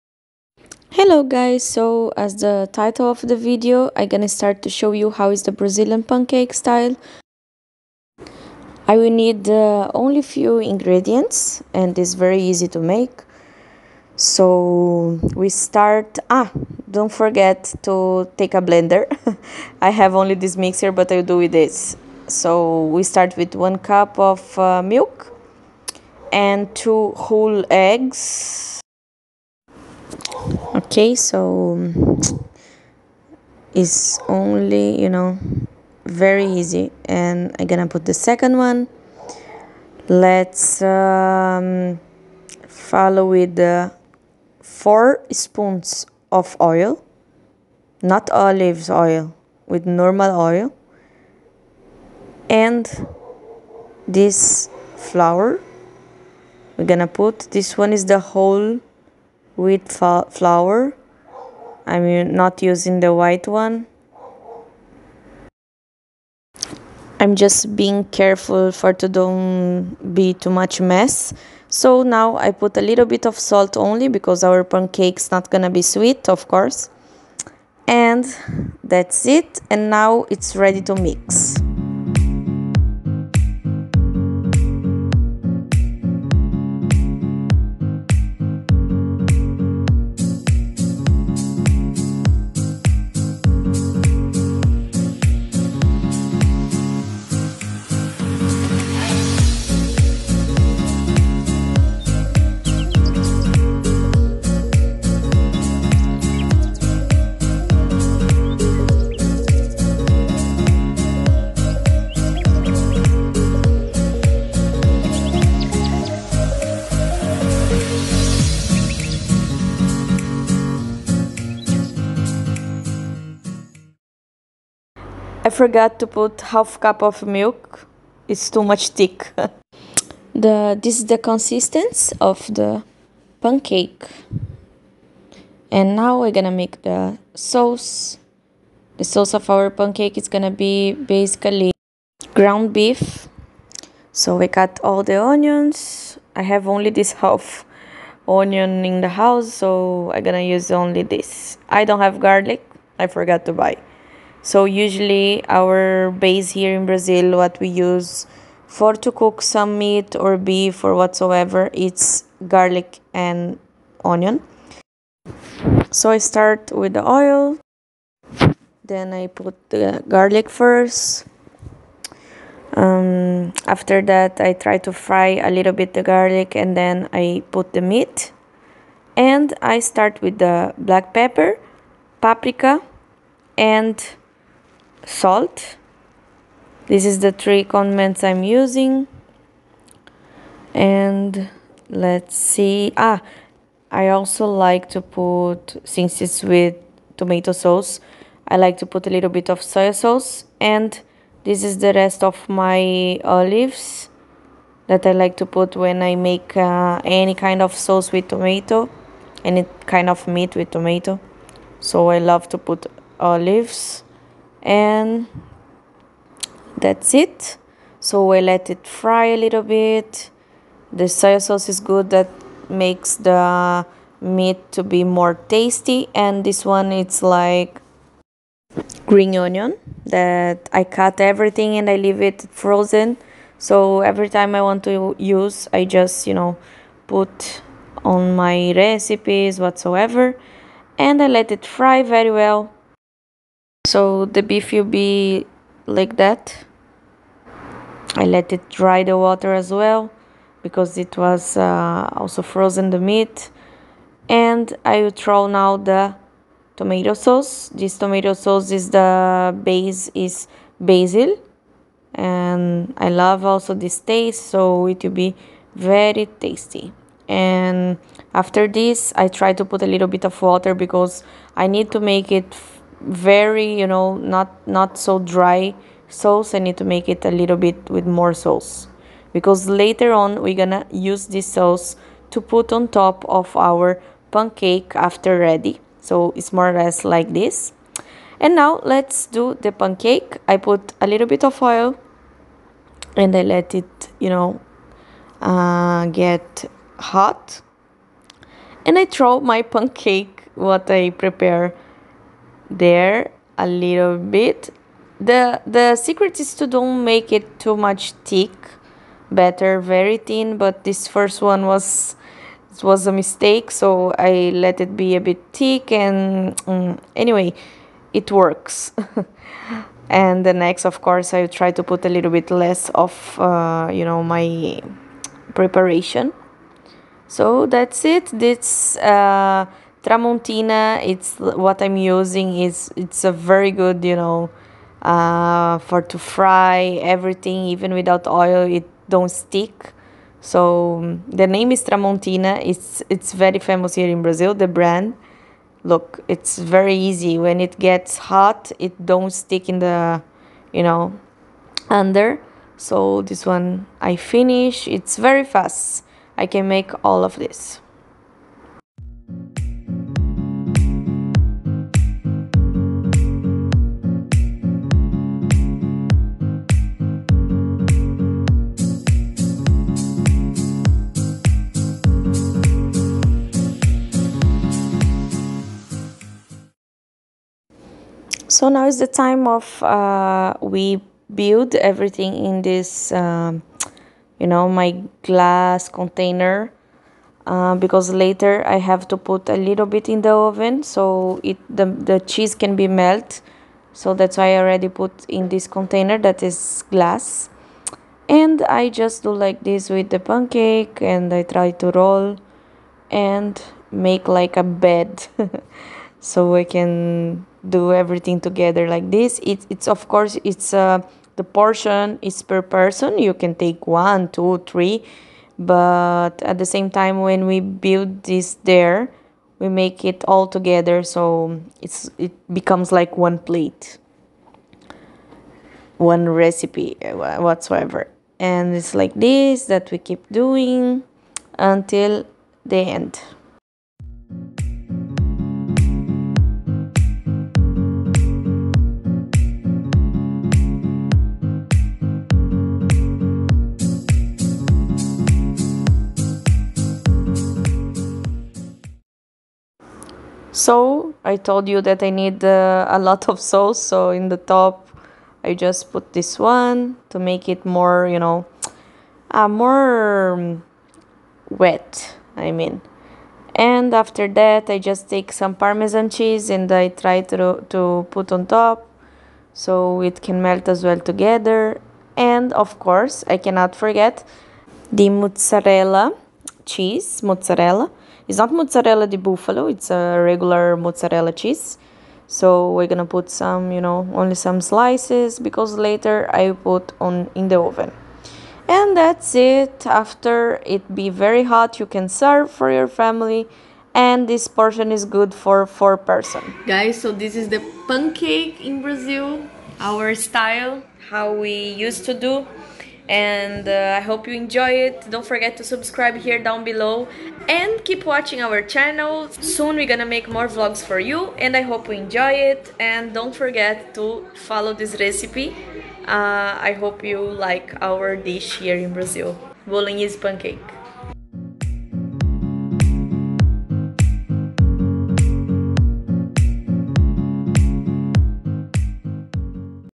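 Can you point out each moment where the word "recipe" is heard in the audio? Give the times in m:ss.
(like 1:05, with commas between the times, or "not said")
3:58, 7:06, 8:35.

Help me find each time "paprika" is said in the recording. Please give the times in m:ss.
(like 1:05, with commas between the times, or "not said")
3:02.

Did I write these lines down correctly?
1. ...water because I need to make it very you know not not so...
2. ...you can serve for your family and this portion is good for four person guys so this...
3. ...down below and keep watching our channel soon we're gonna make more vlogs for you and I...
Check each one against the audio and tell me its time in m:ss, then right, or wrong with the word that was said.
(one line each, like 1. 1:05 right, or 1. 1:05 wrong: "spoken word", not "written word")
1. 4:30 right
2. 8:11 right
3. 8:26 right.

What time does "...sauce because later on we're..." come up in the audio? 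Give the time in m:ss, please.
4:38.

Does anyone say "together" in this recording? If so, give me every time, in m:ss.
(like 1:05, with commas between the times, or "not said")
6:48, 7:00, 7:50.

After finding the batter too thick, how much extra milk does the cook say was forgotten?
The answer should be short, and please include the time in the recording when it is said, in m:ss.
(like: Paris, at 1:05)
half cup, at 2:06.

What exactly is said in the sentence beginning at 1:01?
I'm not using the white one.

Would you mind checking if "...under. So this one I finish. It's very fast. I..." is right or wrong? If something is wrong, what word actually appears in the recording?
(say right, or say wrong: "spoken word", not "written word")
right.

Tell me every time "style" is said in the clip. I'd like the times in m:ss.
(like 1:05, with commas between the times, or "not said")
0:06, 8:20.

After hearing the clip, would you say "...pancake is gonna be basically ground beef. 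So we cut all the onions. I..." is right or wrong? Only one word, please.
right.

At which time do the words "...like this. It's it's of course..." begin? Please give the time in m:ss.
6:48.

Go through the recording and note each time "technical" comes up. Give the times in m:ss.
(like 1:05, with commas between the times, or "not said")
not said.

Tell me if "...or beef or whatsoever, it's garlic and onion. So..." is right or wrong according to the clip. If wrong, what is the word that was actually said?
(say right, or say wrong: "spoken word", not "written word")
right.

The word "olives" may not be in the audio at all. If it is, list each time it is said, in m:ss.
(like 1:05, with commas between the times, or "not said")
0:48, 3:23, 3:33.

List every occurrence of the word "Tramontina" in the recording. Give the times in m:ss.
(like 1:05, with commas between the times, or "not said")
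5:30, 5:41.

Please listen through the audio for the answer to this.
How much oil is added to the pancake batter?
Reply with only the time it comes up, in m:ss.
0:44.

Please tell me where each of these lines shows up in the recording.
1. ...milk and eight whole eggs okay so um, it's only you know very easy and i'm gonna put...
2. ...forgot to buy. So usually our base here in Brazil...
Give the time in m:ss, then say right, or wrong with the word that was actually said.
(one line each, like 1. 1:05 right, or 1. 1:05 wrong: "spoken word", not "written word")
1. 0:24 wrong: "two", not "eight"
2. 2:33 right.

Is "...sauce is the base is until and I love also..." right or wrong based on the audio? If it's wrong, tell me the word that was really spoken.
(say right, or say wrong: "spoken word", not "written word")
wrong: "basil", not "until".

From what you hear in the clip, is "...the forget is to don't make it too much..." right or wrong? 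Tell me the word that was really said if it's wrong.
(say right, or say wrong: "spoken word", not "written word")
wrong: "secret", not "forget".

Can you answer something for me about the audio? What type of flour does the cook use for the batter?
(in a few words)
whole wheat flour.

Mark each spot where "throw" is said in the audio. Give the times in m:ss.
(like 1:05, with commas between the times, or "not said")
4:15, 4:59.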